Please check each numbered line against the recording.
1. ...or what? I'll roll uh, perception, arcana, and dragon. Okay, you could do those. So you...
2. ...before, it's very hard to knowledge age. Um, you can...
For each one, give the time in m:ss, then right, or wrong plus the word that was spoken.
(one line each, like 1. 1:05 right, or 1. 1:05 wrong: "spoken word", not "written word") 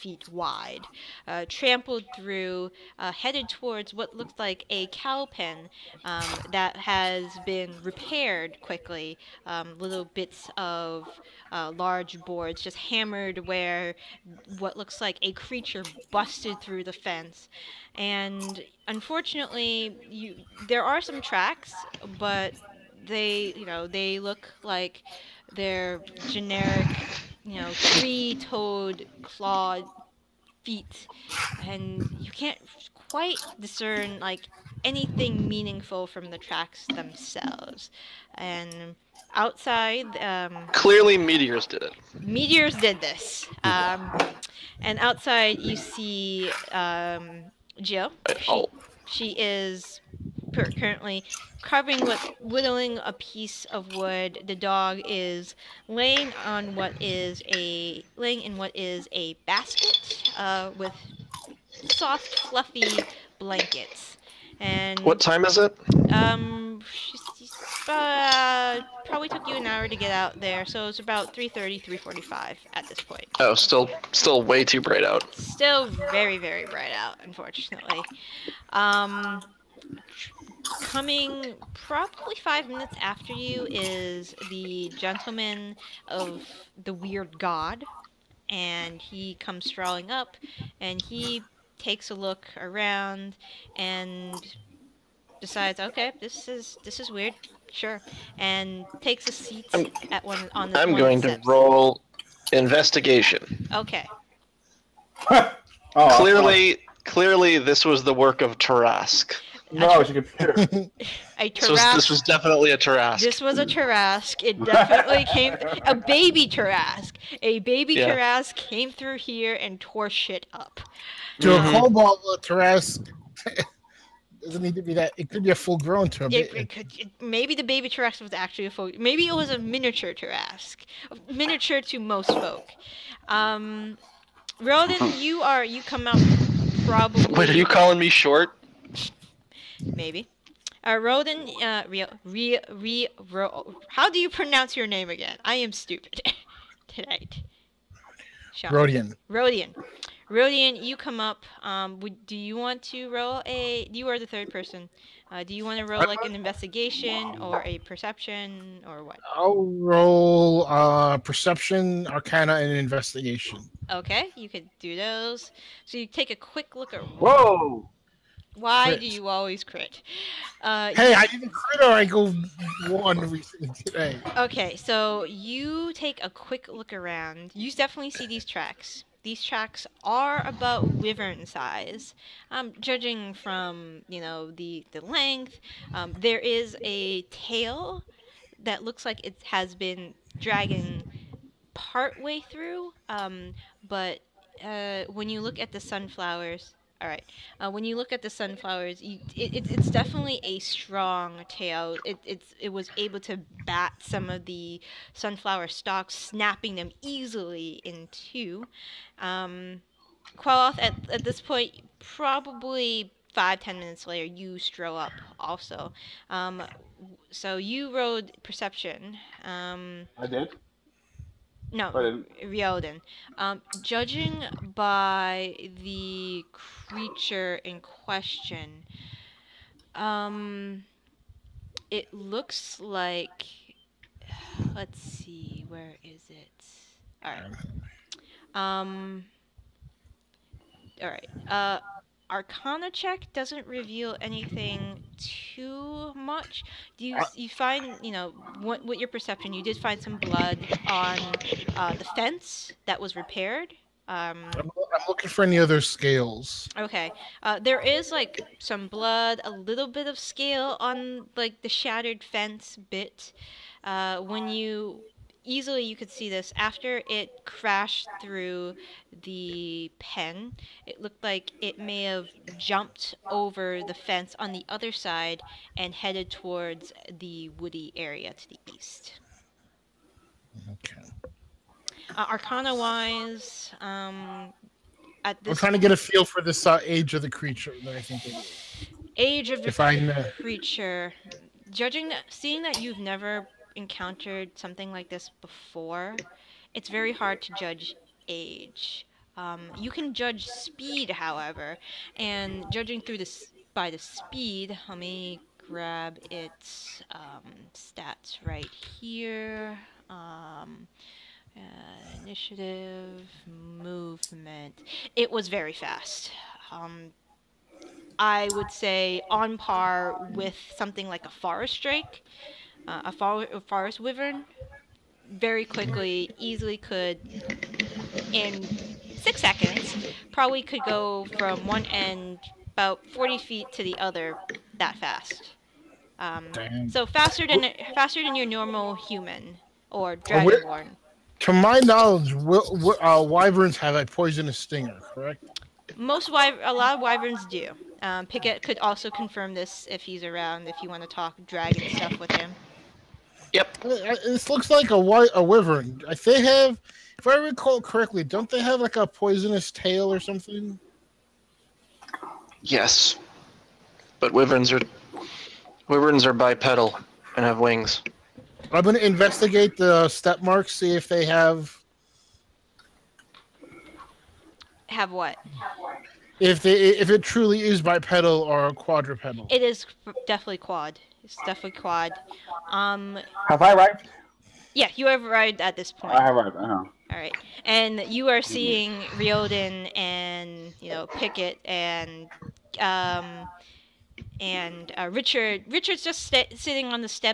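1. 2:38 wrong: "investigation", not "dragon"
2. 4:55 wrong: "judge", not "knowledge".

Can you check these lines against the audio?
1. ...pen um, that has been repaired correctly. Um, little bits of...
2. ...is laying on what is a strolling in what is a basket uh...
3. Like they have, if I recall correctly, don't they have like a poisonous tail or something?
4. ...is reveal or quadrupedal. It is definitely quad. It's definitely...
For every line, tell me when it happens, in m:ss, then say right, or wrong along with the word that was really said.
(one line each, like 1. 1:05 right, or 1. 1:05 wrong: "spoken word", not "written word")
1. 0:05 wrong: "quickly", not "correctly"
2. 0:55 wrong: "laying", not "strolling"
3. 5:56 right
4. 6:17 wrong: "bipedal", not "reveal".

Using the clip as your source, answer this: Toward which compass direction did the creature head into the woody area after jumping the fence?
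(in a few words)
East.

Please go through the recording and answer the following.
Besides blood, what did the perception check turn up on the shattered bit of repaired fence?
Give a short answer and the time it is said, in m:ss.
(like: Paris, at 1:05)
Scale, at 4:20.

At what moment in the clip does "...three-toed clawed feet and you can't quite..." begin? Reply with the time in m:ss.
0:27.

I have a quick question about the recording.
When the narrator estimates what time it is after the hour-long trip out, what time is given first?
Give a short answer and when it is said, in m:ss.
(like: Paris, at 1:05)
3:30, at 1:11.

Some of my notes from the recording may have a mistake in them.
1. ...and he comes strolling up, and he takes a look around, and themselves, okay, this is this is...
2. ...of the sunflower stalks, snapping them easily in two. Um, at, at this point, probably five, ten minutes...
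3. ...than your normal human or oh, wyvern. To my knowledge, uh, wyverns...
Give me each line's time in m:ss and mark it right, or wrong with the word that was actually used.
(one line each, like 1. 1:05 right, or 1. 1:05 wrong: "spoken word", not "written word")
1. 1:28 wrong: "decides", not "themselves"
2. 3:24 right
3. 5:38 wrong: "dragonborn", not "wyvern".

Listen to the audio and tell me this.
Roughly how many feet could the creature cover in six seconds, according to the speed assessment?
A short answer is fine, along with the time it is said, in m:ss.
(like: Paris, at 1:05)
40 feet, at 5:33.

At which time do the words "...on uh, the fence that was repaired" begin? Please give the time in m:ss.
4:10.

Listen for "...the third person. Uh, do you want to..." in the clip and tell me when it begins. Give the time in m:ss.
2:34.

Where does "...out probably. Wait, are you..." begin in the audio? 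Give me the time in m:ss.
2:16.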